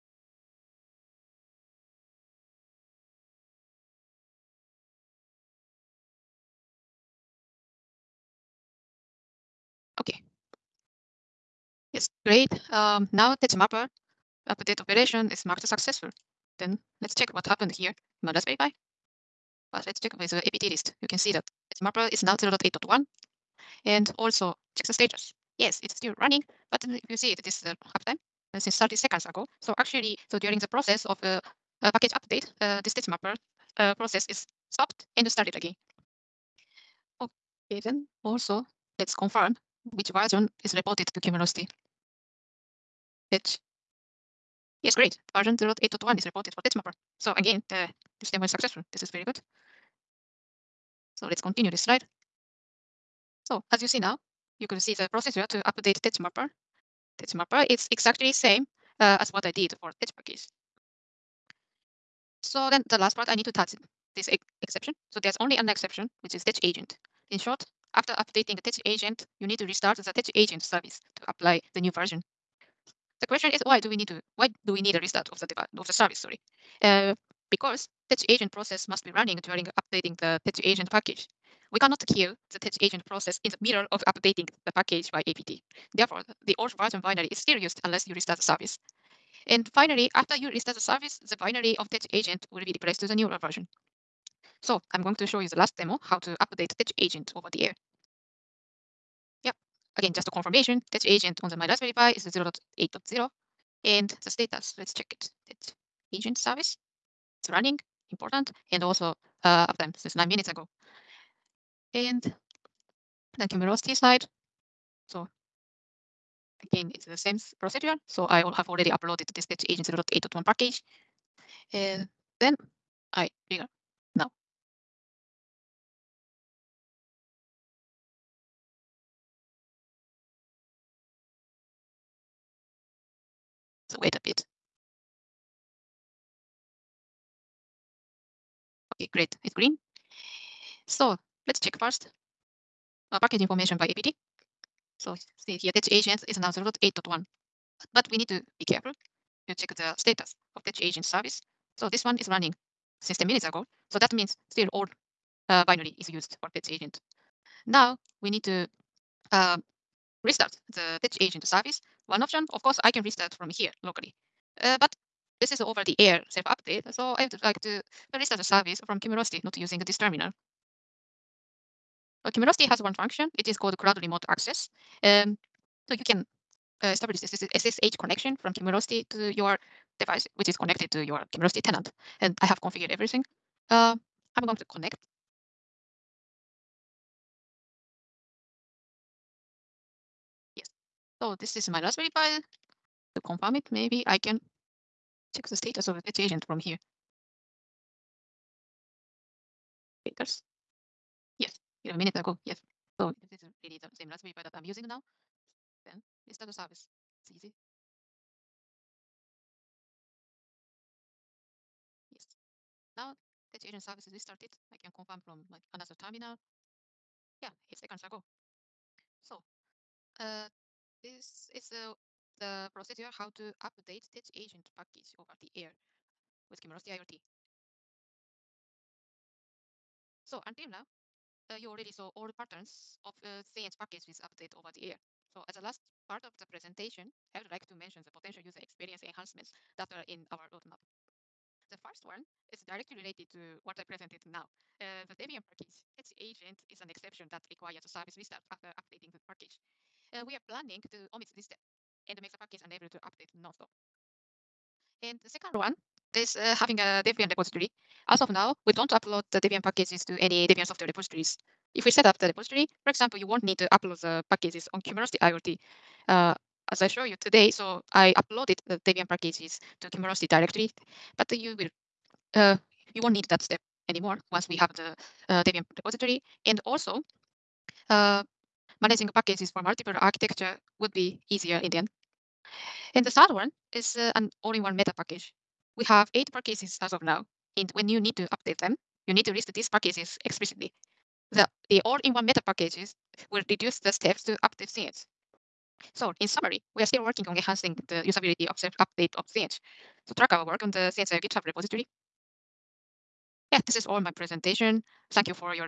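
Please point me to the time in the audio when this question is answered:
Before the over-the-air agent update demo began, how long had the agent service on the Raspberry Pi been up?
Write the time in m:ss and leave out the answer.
1:50.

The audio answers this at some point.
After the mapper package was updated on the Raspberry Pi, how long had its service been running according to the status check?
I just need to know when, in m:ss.
0:28.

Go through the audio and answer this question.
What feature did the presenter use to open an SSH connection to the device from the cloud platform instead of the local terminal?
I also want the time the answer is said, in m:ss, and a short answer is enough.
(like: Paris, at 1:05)
cloud remote access, at 2:53.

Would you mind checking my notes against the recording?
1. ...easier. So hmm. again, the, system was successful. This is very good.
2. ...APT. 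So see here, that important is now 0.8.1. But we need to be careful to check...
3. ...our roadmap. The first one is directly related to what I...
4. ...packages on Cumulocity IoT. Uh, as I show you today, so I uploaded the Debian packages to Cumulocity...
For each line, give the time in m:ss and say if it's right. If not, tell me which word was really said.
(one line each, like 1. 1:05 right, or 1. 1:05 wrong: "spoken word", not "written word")
1. 0:46 wrong: "mapper", not "easier"
2. 2:23 wrong: "agent", not "important"
3. 4:00 right
4. 4:24 right.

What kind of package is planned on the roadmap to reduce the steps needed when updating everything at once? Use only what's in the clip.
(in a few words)
all-in-one meta package.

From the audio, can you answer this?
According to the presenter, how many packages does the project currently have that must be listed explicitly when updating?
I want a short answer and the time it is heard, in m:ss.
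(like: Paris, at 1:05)
8, at 4:46.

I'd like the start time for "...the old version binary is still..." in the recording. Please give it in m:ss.
1:26.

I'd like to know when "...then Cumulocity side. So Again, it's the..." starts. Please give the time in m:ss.
1:53.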